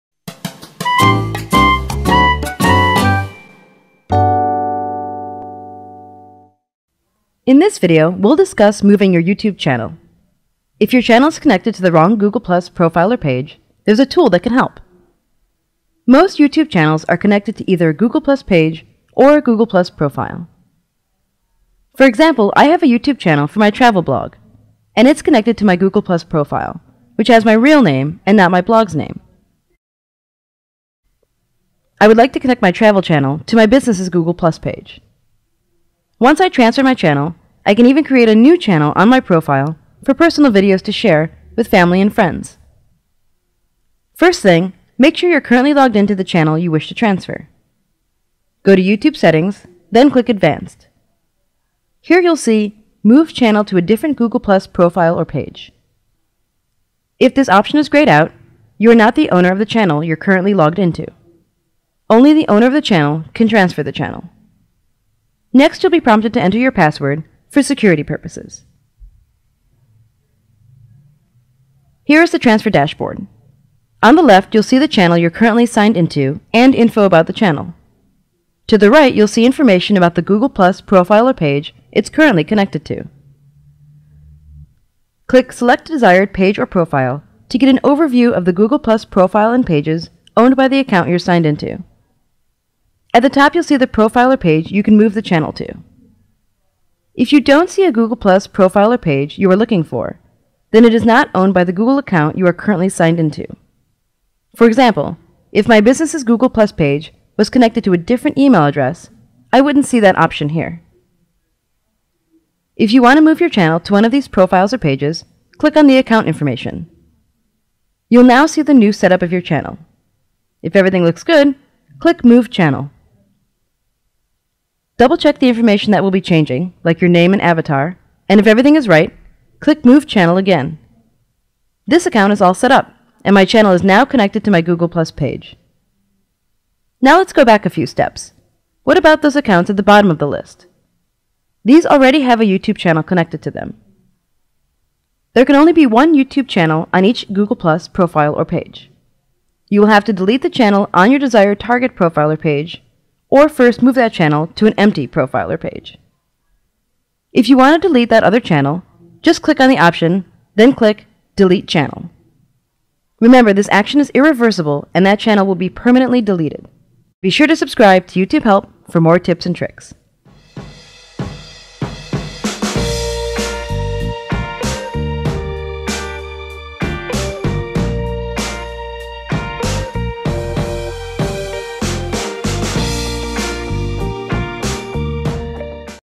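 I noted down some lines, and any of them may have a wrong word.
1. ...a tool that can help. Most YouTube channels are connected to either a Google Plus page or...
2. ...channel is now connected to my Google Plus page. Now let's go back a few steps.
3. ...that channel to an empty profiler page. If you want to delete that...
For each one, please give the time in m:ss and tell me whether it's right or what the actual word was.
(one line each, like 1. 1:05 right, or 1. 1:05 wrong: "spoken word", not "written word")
1. 0:13 right
2. 2:13 right
3. 2:33 right.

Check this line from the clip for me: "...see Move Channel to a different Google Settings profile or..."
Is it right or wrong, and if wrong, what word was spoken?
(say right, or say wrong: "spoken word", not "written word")
wrong: "Plus", not "Settings".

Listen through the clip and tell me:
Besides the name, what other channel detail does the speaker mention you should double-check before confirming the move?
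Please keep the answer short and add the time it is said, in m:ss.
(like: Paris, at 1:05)
avatar, at 2:07.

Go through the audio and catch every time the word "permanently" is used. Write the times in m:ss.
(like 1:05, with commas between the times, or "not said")
2:45.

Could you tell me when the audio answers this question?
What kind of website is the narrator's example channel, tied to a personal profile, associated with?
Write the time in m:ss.
0:23.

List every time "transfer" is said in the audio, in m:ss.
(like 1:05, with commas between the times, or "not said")
0:36, 0:46, 1:03, 1:12.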